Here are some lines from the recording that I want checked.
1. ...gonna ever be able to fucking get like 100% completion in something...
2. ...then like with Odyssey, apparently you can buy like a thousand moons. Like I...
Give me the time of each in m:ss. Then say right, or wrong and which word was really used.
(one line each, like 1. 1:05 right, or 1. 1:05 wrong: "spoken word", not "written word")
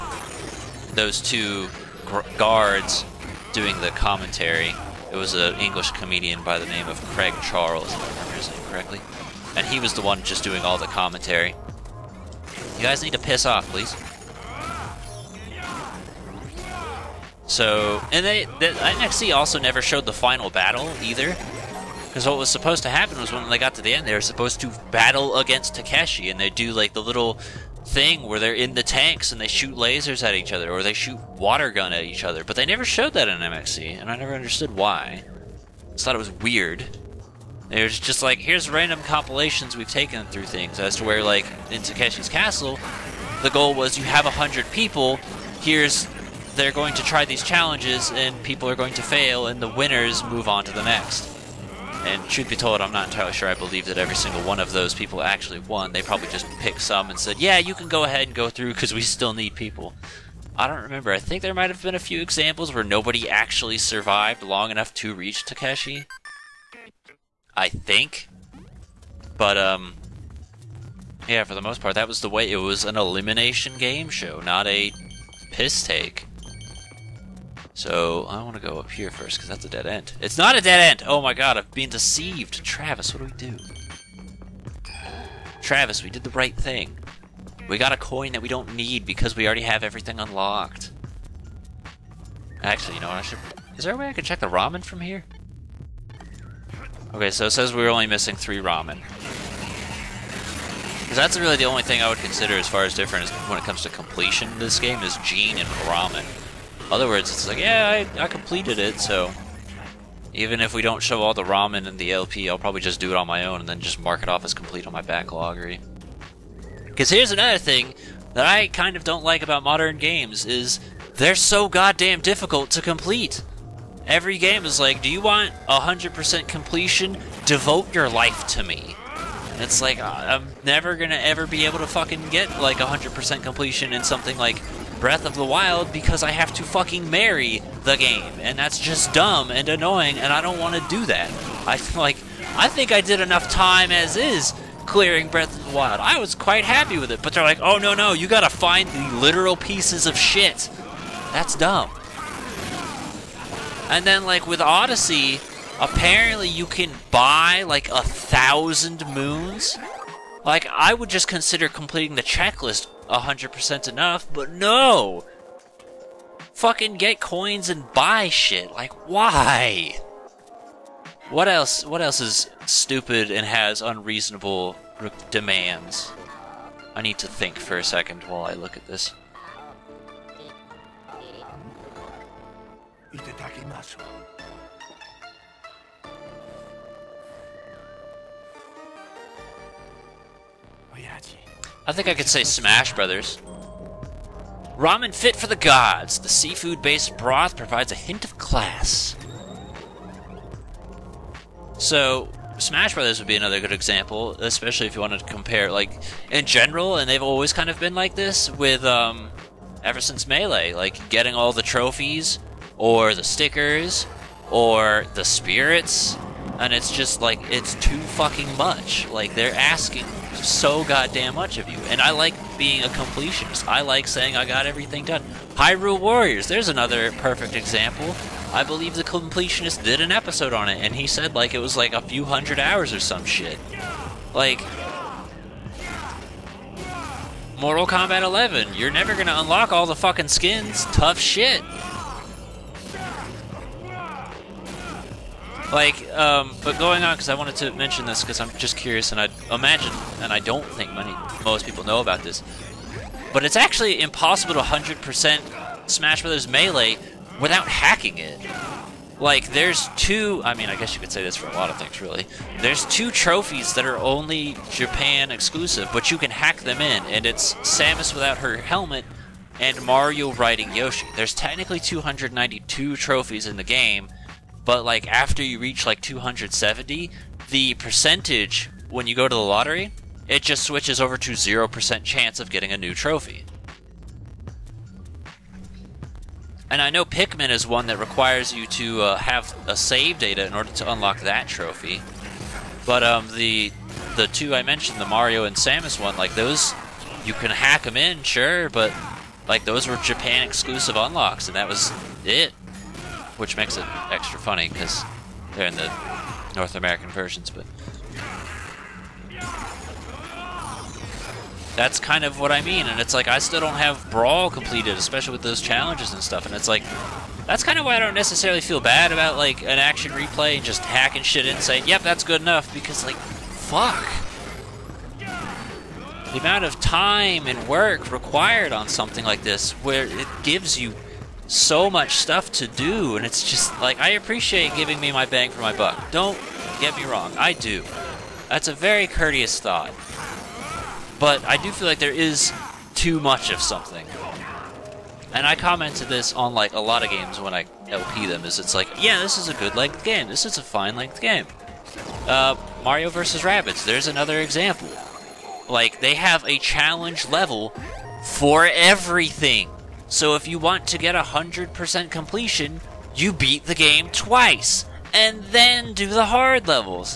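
1. 2:10 right
2. 2:34 right.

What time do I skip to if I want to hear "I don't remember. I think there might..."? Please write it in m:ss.
1:00.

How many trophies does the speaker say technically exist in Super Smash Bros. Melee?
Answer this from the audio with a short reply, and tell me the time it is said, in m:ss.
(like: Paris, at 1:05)
292, at 4:31.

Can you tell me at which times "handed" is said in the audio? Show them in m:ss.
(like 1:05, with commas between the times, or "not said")
not said.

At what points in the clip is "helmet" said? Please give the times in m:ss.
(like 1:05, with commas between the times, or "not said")
4:28.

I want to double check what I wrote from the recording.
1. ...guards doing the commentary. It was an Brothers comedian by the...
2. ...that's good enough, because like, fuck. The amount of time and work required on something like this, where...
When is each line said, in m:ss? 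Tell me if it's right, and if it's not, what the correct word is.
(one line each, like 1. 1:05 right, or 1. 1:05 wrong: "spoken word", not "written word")
1. 0:02 wrong: "English", not "Brothers"
2. 5:22 right.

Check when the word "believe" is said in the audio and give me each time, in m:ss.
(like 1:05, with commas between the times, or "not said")
0:53, 3:48.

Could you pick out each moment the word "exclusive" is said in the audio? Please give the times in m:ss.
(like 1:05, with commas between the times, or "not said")
4:25, 5:00.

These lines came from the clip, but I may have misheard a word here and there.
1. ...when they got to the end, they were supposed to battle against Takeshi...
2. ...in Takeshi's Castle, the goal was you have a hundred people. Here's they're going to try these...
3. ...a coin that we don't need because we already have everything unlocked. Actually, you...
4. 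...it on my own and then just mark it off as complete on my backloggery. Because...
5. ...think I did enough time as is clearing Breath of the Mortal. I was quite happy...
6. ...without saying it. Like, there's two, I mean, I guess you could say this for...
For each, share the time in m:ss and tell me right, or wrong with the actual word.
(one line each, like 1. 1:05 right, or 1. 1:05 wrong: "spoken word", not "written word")
1. 0:23 right
2. 0:41 right
3. 1:27 right
4. 1:53 right
5. 2:22 wrong: "Wild", not "Mortal"
6. 4:17 wrong: "hacking", not "saying".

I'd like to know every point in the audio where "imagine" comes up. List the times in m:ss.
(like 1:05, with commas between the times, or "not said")
4:09.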